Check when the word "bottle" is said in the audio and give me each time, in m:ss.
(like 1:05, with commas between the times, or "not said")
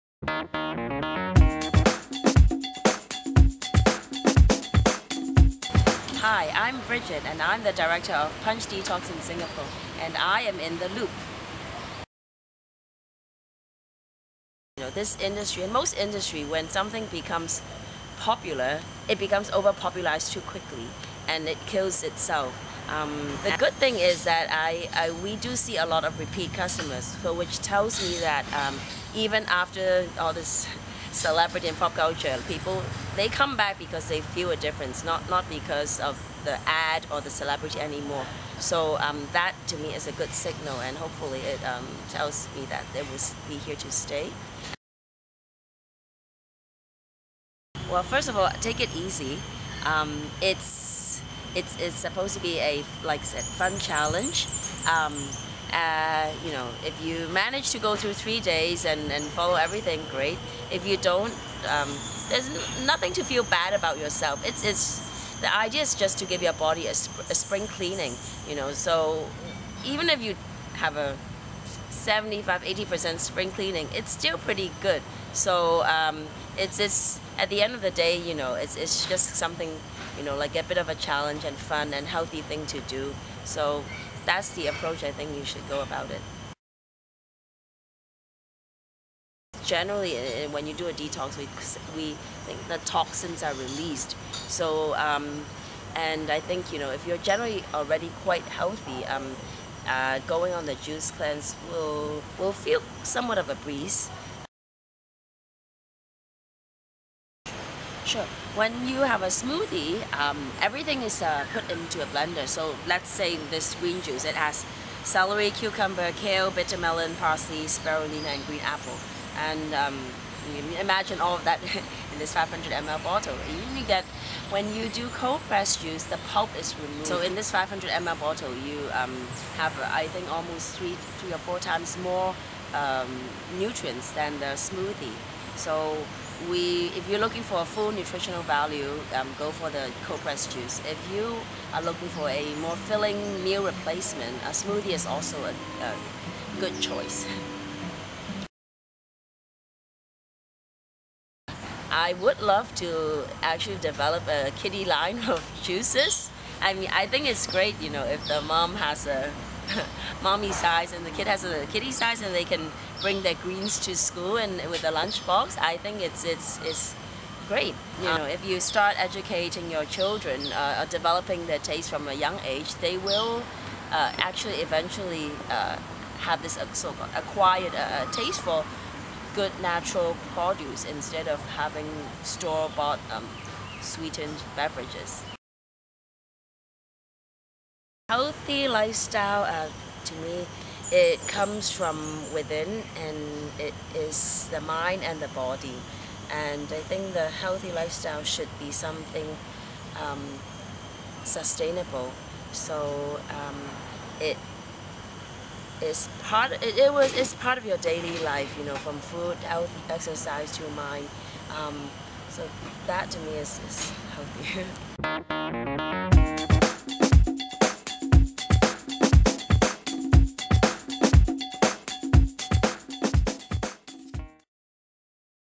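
2:03, 2:08.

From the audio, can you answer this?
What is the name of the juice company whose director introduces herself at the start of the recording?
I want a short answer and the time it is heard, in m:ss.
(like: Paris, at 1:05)
Punch Detox, at 0:08.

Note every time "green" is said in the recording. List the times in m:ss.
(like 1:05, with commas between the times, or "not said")
1:53, 1:58, 2:43.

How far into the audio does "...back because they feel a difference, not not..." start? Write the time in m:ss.
0:33.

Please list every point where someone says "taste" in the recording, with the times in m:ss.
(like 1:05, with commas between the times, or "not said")
2:51, 2:58.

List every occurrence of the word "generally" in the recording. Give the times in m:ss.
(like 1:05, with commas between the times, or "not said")
1:29, 1:37.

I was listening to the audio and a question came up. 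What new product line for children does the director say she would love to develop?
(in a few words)
kiddie line.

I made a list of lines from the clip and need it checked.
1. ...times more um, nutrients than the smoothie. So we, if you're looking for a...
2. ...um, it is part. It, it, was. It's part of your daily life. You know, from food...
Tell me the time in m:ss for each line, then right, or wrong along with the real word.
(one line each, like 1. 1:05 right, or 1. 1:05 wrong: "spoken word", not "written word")
1. 2:11 right
2. 3:23 right.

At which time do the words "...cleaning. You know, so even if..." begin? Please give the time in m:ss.
1:07.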